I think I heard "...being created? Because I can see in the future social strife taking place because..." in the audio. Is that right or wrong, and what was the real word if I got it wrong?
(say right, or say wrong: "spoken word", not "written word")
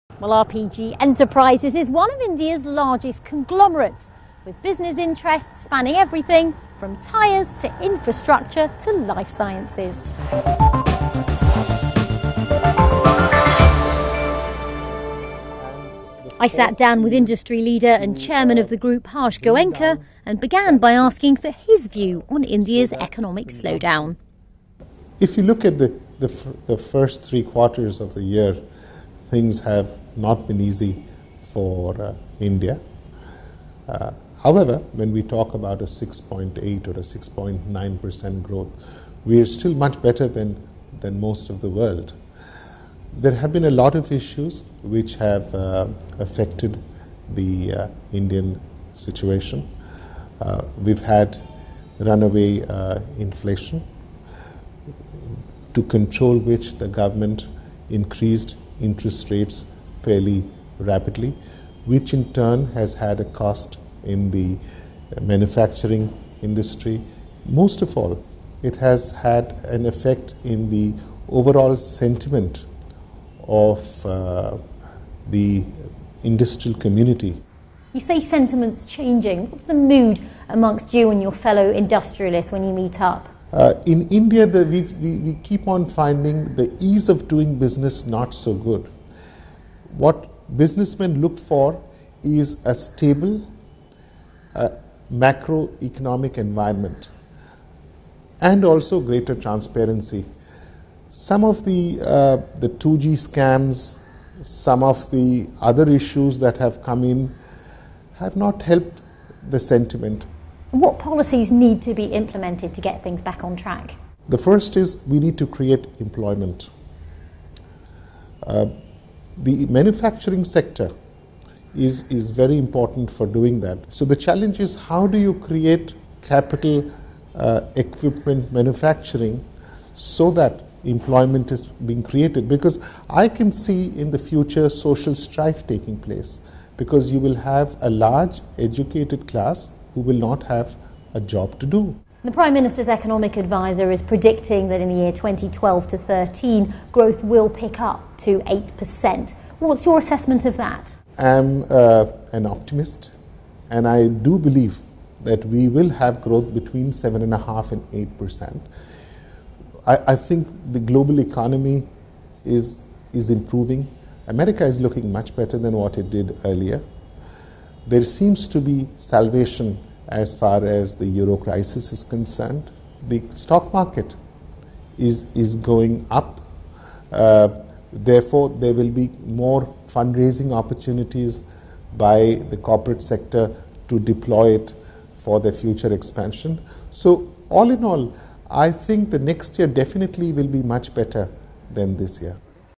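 right.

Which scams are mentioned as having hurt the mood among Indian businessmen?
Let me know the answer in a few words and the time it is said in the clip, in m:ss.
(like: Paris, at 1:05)
2G scams, at 1:42.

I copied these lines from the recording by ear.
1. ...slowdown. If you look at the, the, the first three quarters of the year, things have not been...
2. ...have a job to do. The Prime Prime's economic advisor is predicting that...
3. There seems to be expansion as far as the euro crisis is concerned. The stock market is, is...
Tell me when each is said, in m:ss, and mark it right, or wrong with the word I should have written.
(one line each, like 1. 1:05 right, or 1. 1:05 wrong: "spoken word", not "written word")
1. 0:23 right
2. 2:20 wrong: "Minister", not "Prime"
3. 2:47 wrong: "salvation", not "expansion".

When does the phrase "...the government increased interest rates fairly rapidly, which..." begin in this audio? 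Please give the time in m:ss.
0:56.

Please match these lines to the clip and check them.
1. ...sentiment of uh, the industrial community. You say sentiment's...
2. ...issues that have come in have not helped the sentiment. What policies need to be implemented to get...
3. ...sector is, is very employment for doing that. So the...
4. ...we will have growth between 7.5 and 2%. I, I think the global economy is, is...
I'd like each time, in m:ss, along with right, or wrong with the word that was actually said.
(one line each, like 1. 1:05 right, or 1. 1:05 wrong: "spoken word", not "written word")
1. 1:11 right
2. 1:45 right
3. 2:00 wrong: "important", not "employment"
4. 2:35 wrong: "8", not "2".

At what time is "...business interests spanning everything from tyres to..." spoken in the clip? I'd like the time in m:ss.
0:04.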